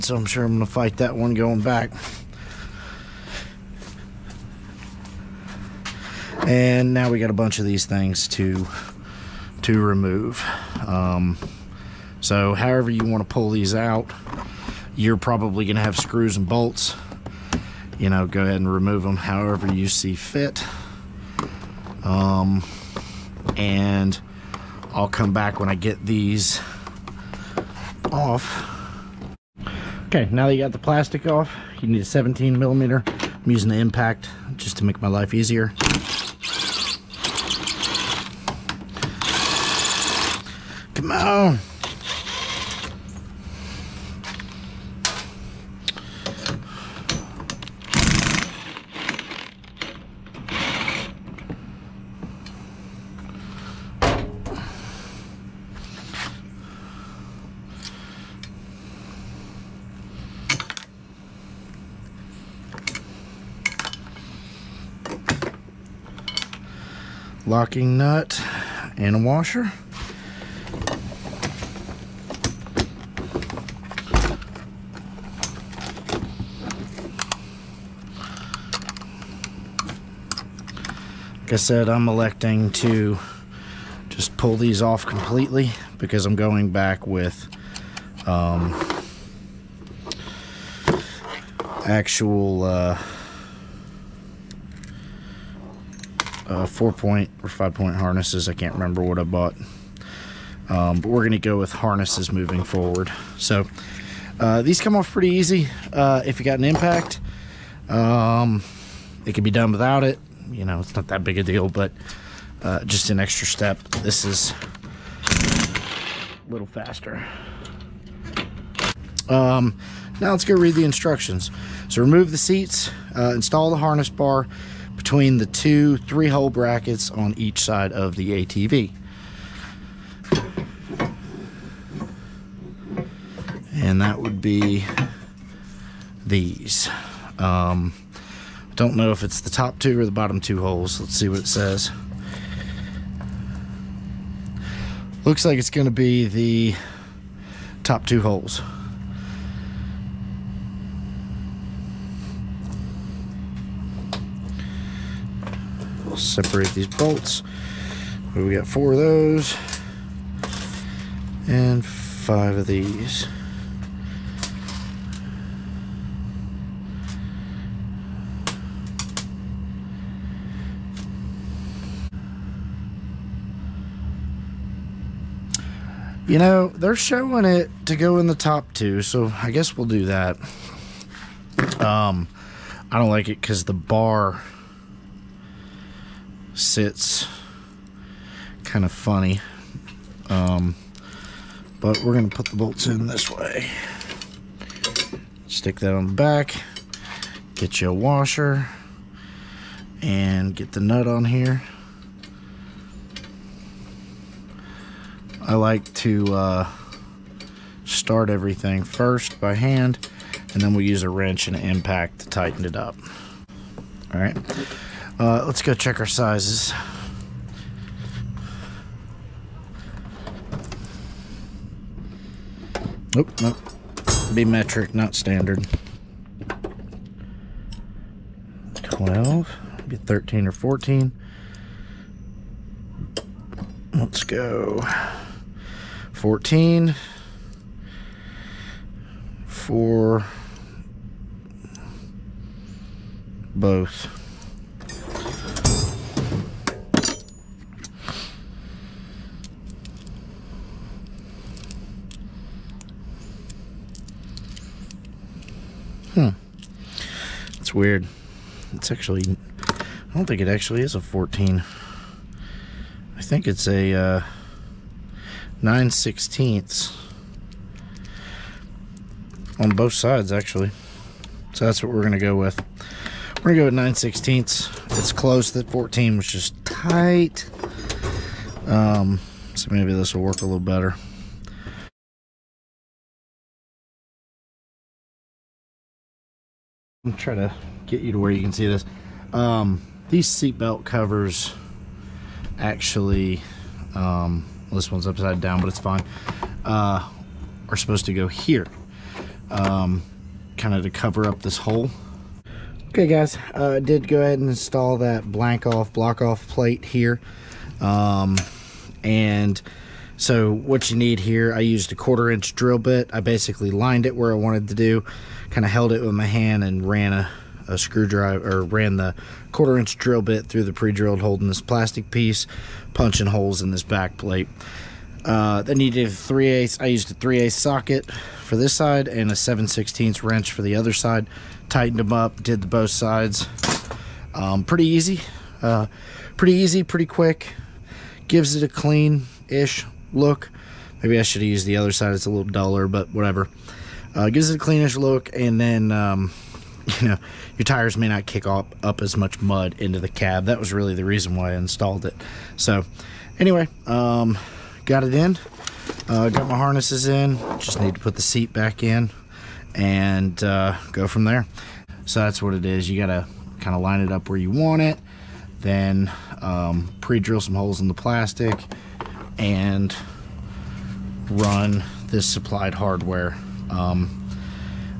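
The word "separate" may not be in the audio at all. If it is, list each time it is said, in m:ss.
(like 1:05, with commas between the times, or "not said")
2:36.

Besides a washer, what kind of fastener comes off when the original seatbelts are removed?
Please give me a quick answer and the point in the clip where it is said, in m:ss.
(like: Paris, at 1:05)
locking nut, at 1:07.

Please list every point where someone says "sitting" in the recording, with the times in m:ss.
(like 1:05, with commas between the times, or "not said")
not said.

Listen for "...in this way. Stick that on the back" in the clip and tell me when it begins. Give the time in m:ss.
3:12.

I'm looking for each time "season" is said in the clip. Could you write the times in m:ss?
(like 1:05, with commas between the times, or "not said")
not said.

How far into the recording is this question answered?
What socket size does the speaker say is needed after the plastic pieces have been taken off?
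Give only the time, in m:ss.
0:32.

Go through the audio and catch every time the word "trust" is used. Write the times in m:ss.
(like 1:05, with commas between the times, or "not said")
not said.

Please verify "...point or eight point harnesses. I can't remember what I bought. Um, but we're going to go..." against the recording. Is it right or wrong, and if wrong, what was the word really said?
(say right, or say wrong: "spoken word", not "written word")
wrong: "five", not "eight".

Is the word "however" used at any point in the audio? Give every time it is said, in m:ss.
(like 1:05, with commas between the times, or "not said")
0:12, 0:19.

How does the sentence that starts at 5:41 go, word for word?
Maybe I should have used the other side.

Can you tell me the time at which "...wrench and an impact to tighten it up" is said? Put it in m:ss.
3:31.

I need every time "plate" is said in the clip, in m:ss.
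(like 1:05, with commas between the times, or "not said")
5:06, 5:24.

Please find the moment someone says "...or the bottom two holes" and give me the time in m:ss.
2:19.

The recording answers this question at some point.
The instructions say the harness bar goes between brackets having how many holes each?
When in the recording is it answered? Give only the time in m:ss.
2:05.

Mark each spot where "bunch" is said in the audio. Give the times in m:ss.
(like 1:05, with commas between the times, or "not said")
0:07.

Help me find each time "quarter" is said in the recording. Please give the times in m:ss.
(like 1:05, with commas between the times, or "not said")
5:11, 5:19.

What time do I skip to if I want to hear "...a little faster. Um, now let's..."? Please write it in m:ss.
1:56.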